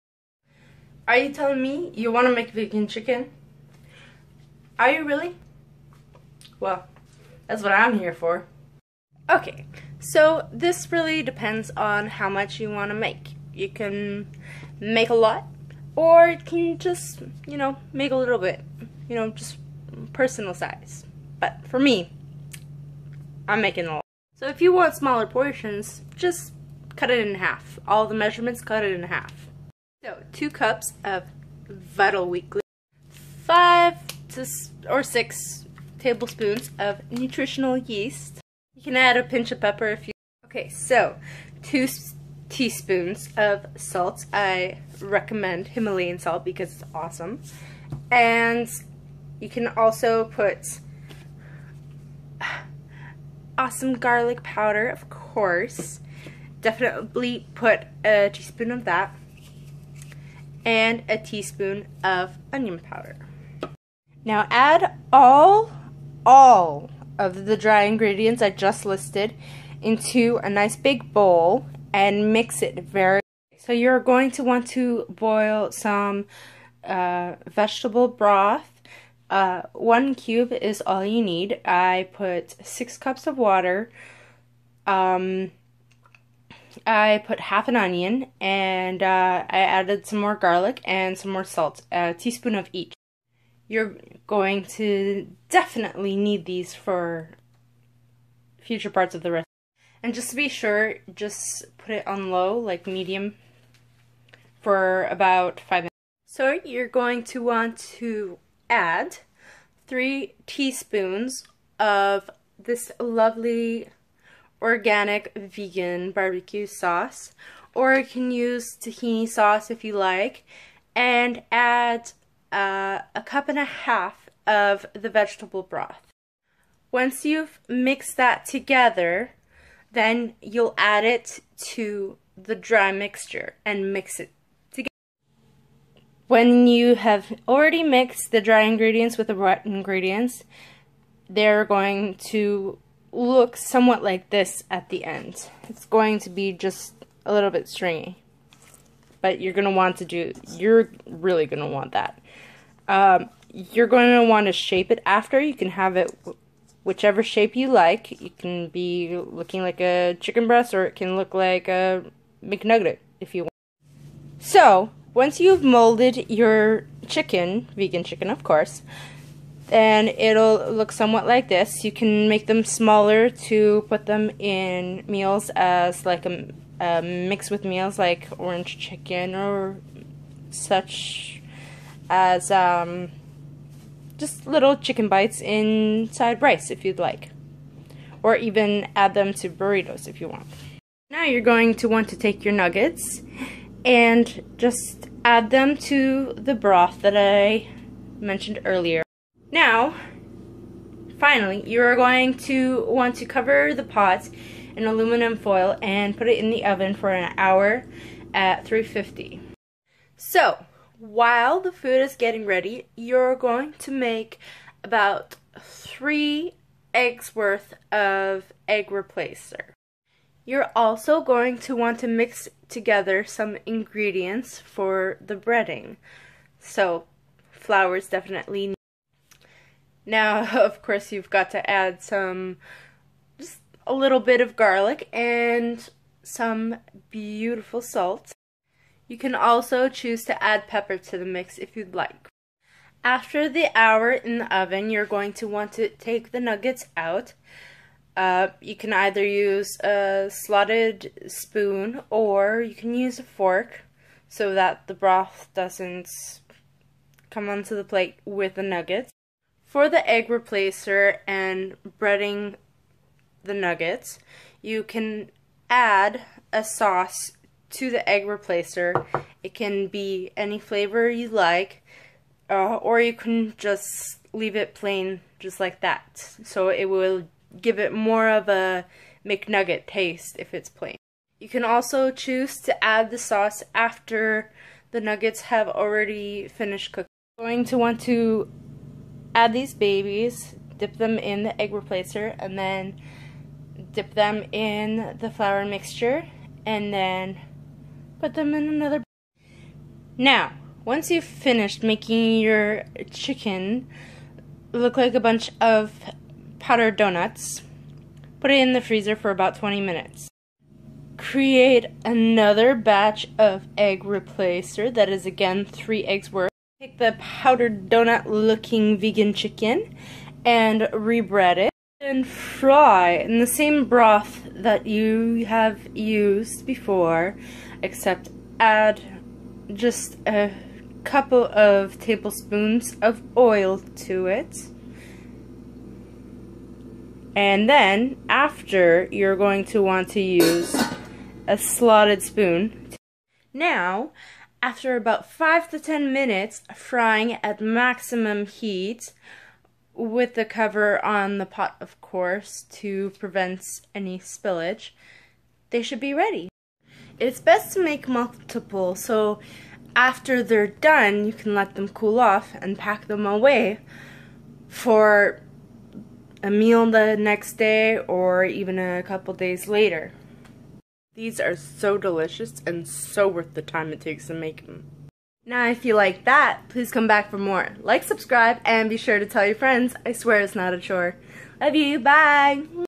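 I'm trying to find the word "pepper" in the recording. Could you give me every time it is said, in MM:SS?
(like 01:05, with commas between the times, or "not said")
00:39, 04:00.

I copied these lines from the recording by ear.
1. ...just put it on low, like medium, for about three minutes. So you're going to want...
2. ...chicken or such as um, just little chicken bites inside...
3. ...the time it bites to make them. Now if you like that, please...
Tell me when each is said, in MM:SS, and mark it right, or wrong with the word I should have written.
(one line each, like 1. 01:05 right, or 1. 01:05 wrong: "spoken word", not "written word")
1. 01:41 wrong: "five", not "three"
2. 02:58 right
3. 06:13 wrong: "takes", not "bites".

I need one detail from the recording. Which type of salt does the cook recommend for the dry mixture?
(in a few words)
Himalayan salt.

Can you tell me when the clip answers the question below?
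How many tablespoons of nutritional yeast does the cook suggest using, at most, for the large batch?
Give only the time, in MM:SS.
00:35.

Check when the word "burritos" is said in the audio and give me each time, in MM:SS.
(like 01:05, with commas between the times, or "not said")
03:09.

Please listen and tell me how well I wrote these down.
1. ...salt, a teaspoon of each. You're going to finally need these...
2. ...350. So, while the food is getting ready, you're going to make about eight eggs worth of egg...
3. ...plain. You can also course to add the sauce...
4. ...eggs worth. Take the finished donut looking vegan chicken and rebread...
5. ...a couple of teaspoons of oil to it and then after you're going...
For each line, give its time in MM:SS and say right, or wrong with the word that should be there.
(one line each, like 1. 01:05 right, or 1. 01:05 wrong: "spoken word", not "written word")
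1. 01:31 wrong: "definitely", not "finally"
2. 03:28 wrong: "three", not "eight"
3. 04:40 wrong: "choose", not "course"
4. 05:16 wrong: "powdered", not "finished"
5. 05:30 wrong: "tablespoons", not "teaspoons".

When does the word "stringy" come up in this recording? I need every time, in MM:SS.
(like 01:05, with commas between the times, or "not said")
02:27.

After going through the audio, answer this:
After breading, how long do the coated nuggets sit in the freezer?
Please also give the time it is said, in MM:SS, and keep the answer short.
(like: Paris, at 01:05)
20 minutes, at 05:09.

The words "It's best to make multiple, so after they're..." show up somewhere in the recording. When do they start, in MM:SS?
05:57.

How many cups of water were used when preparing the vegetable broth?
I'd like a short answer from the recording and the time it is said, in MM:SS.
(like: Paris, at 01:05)
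6, at 01:22.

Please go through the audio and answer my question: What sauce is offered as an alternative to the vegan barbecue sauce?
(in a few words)
Tahini sauce.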